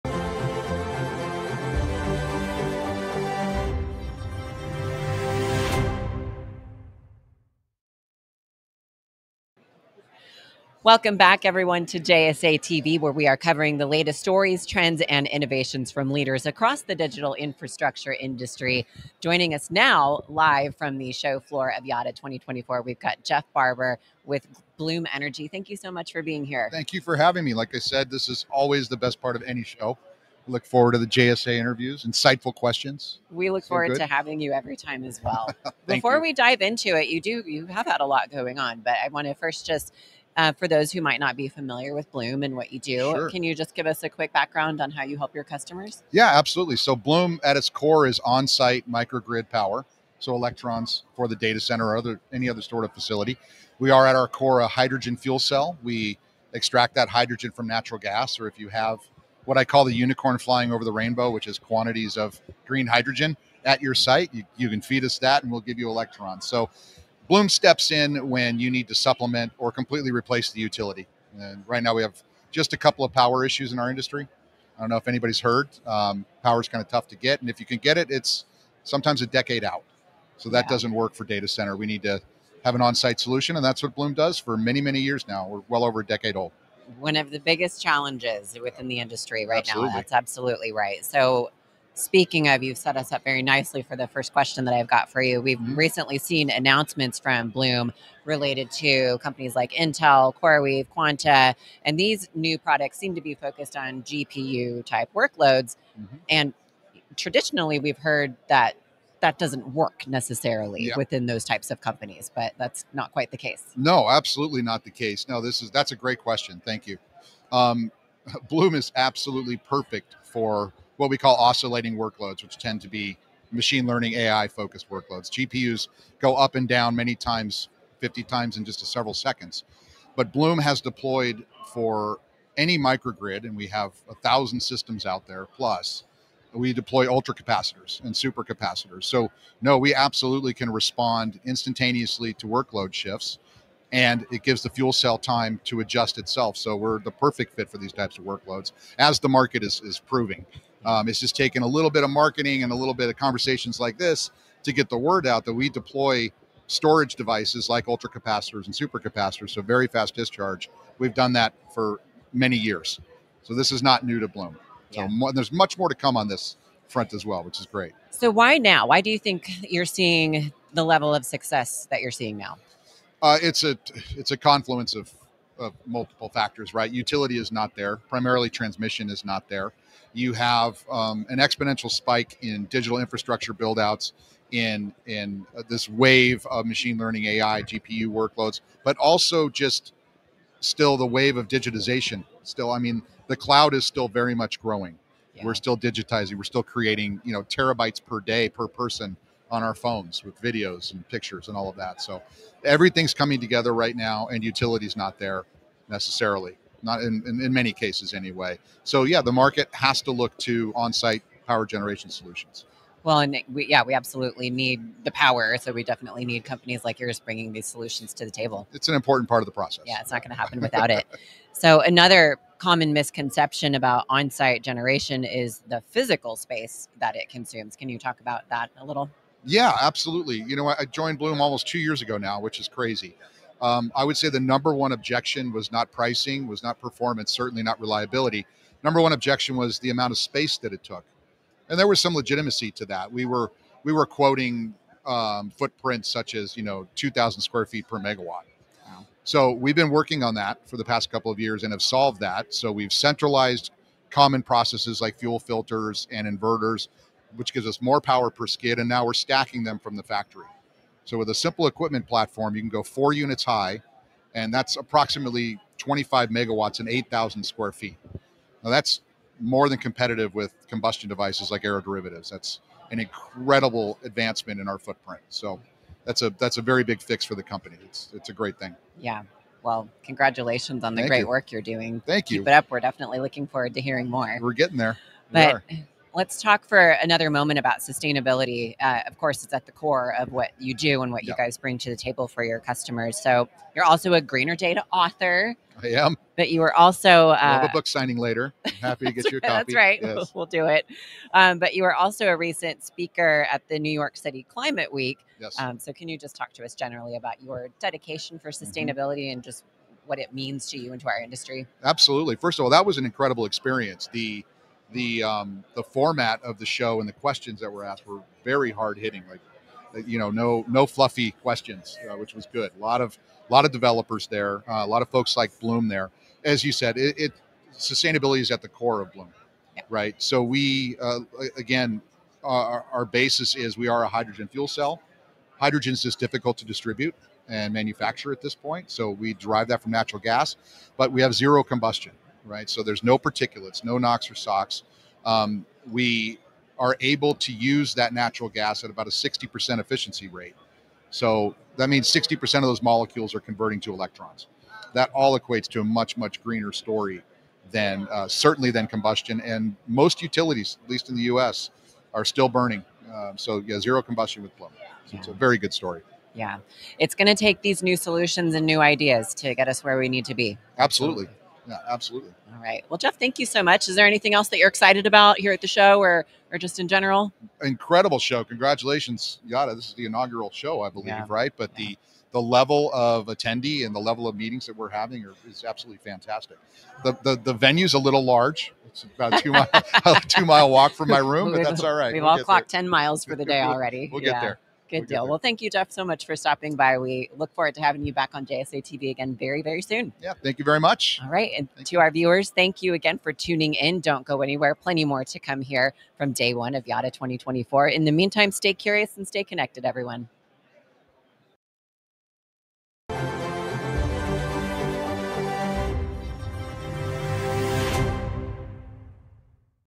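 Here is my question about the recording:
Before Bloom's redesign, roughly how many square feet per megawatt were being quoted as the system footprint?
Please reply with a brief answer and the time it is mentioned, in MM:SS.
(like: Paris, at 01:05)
2,000, at 04:06.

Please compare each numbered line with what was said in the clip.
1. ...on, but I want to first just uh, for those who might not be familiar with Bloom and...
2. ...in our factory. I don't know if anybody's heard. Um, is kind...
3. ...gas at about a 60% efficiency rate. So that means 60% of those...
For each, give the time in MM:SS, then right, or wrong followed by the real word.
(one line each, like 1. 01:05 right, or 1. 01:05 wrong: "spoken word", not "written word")
1. 00:38 right
2. 01:13 wrong: "industry", not "factory"
3. 05:48 right.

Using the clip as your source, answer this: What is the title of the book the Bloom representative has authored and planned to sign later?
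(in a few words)
Greener Data.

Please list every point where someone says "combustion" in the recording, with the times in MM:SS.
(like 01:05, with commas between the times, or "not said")
04:30, 05:41, 05:58, 06:04.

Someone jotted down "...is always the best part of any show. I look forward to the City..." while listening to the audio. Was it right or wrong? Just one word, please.
wrong.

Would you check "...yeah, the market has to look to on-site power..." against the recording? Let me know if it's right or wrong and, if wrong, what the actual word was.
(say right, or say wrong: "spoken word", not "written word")
right.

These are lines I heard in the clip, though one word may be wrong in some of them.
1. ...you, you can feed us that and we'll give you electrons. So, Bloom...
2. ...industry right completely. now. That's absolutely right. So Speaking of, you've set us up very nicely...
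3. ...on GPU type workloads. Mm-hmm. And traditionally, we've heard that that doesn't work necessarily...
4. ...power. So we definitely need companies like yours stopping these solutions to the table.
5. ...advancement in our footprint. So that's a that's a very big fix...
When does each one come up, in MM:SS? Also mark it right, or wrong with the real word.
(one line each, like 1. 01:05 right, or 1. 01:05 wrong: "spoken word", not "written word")
1. 01:04 right
2. 01:28 wrong: "absolutely", not "completely"
3. 01:43 right
4. 03:35 wrong: "bringing", not "stopping"
5. 04:34 right.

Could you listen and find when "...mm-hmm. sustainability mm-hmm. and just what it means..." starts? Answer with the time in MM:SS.
05:08.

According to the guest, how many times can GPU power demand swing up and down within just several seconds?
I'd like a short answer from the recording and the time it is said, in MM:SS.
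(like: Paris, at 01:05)
50, at 02:08.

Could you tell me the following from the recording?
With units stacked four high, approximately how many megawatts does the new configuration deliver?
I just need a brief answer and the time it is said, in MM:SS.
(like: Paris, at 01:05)
25 megawatts, at 04:25.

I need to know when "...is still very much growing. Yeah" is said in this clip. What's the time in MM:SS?
03:13.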